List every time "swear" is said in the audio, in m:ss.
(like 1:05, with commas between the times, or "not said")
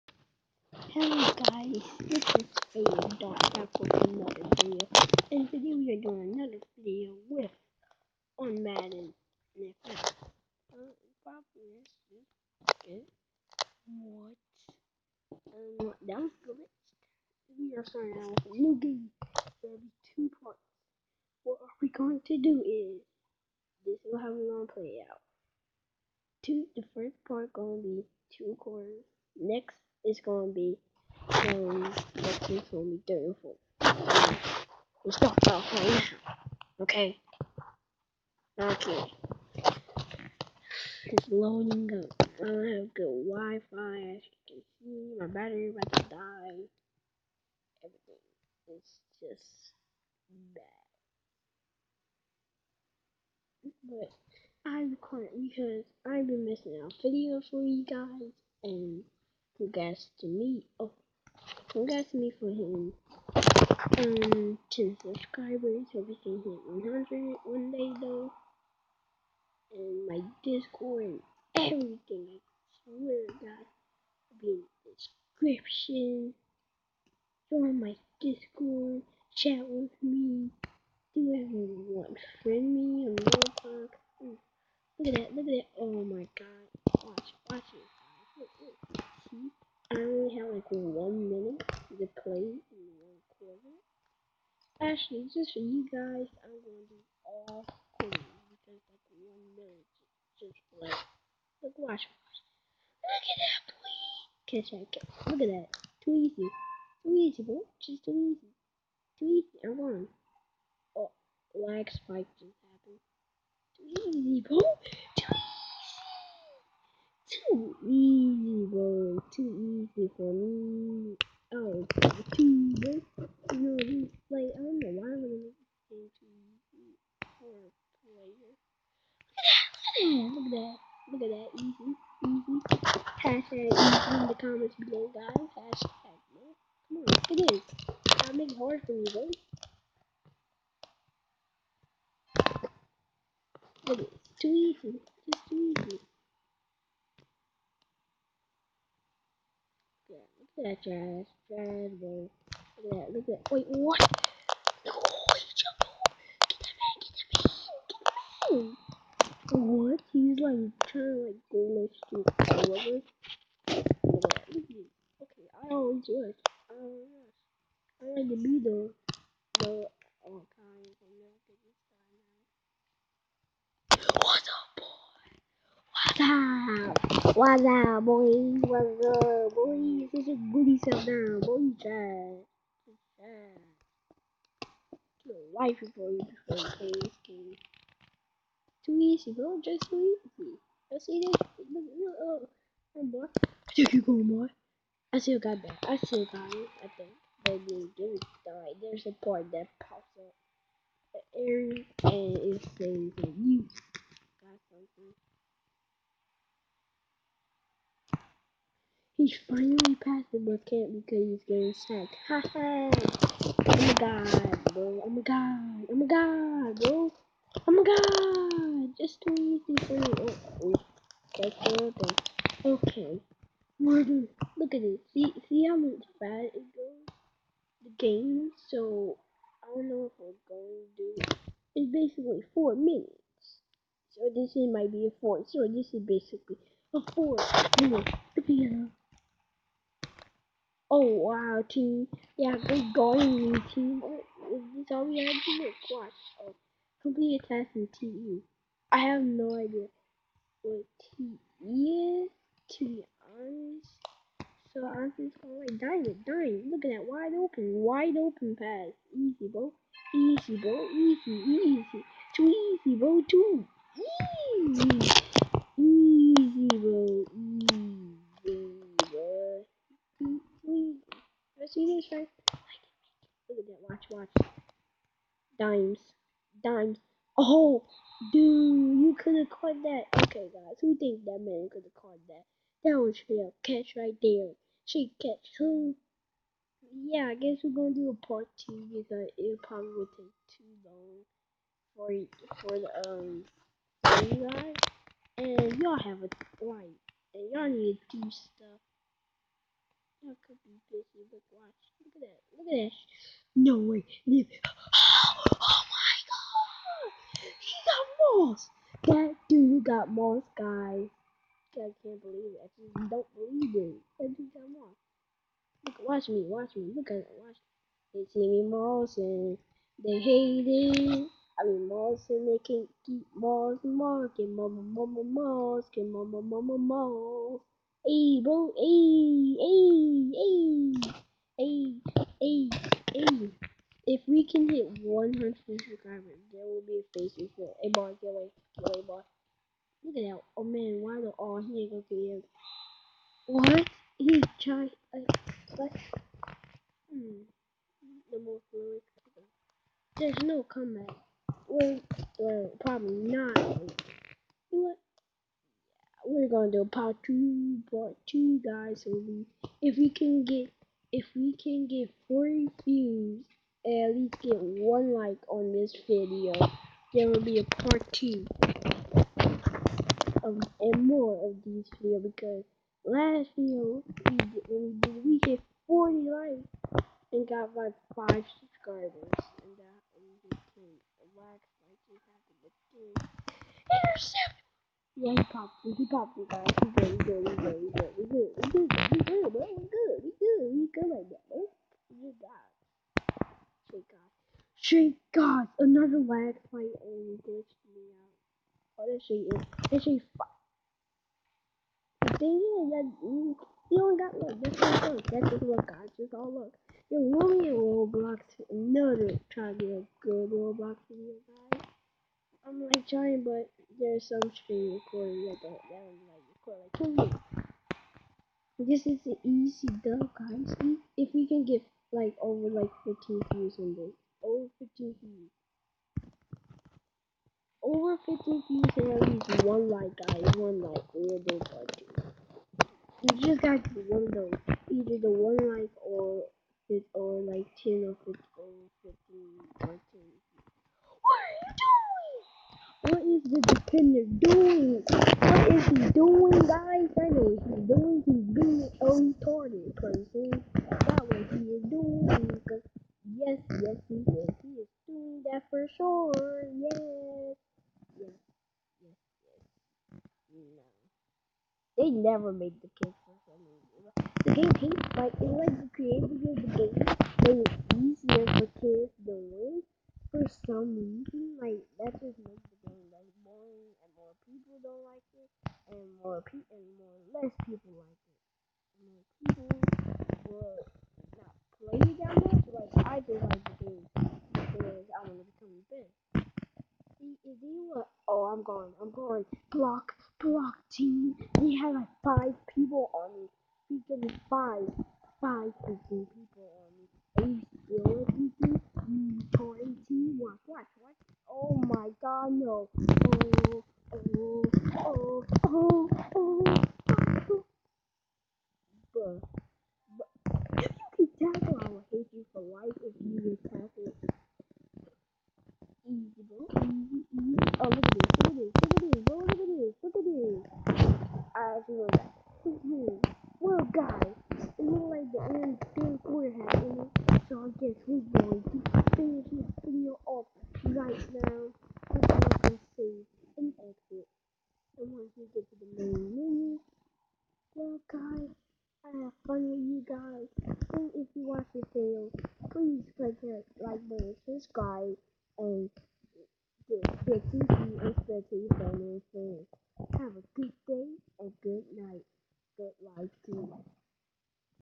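1:12.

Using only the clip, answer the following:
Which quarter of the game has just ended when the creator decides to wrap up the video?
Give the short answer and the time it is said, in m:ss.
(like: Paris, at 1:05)
Third quarter, at 8:45.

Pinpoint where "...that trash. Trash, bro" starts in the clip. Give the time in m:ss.
2:30.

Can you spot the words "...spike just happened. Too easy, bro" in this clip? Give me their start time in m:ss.
1:51.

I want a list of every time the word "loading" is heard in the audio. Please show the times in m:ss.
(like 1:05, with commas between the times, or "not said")
0:41.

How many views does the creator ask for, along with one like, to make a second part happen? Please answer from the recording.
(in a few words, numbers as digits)
40.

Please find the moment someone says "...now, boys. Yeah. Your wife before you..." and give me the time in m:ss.
3:01.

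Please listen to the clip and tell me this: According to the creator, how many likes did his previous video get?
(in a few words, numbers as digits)
40.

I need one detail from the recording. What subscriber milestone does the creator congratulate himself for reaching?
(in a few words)
10.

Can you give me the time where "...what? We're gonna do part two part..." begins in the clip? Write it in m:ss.
5:54.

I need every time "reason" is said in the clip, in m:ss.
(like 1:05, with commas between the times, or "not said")
2:18, 7:43, 7:50.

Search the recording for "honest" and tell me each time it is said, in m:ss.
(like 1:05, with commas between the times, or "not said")
4:13.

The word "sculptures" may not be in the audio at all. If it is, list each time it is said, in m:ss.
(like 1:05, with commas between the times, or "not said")
not said.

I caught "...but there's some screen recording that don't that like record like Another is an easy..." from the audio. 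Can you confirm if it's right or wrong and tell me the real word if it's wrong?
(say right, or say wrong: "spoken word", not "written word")
wrong: "This", not "Another".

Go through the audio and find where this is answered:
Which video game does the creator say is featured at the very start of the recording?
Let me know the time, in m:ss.
0:08.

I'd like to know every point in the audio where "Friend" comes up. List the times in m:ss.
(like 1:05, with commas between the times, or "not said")
1:22.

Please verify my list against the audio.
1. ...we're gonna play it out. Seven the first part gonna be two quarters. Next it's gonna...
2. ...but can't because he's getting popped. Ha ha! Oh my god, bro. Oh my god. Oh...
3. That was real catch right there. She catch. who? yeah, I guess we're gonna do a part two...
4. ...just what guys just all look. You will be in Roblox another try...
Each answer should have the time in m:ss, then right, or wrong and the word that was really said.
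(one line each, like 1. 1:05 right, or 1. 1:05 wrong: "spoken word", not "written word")
1. 0:24 wrong: "Two", not "Seven"
2. 3:30 wrong: "sacked", not "popped"
3. 4:42 right
4. 6:45 right.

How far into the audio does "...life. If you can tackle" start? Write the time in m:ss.
8:32.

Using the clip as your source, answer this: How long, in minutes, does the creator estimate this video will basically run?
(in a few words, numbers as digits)
4.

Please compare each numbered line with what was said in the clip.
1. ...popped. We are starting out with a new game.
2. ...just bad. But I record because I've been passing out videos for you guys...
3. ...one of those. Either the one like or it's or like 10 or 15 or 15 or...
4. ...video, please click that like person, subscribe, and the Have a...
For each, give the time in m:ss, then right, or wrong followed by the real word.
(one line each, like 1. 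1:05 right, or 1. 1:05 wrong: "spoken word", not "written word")
1. 0:16 wrong: "glitched", not "popped"
2. 0:49 wrong: "missing", not "passing"
3. 7:14 right
4. 9:01 wrong: "button", not "person".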